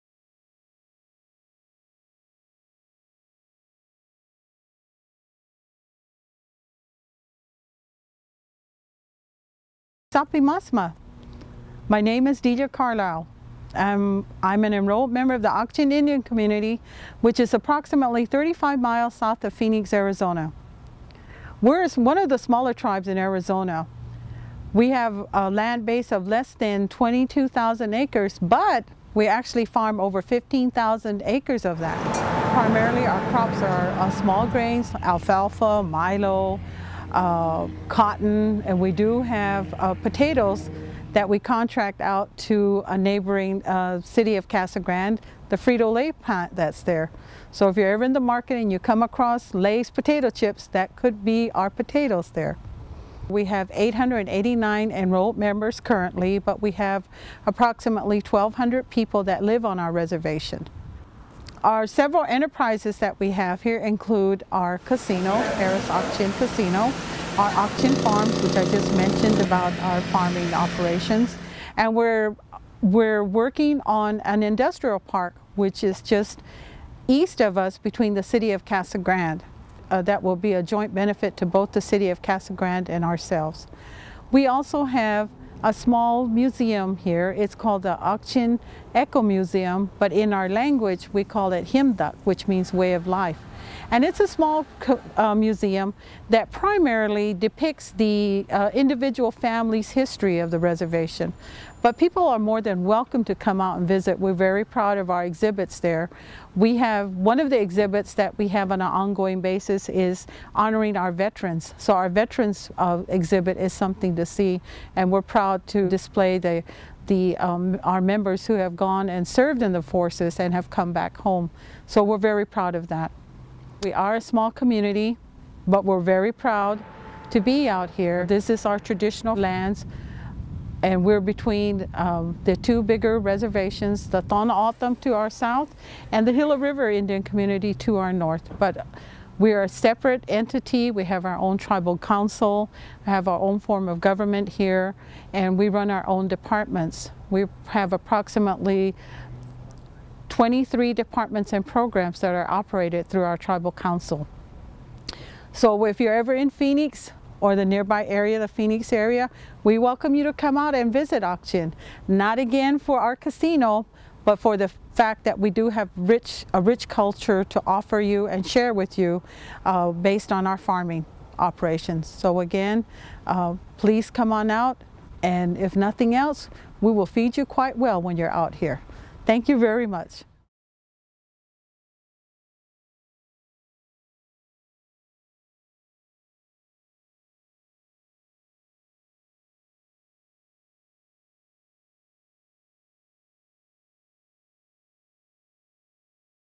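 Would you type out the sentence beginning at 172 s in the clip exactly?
So again, uh, please come on out and if nothing else, we will feed you quite well when you're out here.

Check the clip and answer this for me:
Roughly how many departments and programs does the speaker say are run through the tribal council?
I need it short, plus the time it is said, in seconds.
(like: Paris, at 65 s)
23, at 150 s.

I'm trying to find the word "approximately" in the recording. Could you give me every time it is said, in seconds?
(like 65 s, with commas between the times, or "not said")
17 s, 57 s, 147 s.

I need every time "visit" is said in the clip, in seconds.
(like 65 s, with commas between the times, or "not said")
103 s, 160 s.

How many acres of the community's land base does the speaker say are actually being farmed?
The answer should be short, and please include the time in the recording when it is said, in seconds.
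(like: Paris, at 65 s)
15,000, at 30 s.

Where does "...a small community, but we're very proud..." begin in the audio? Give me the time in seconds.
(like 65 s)
124 s.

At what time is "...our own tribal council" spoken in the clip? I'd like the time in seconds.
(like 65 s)
141 s.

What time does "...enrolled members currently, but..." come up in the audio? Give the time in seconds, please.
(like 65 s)
54 s.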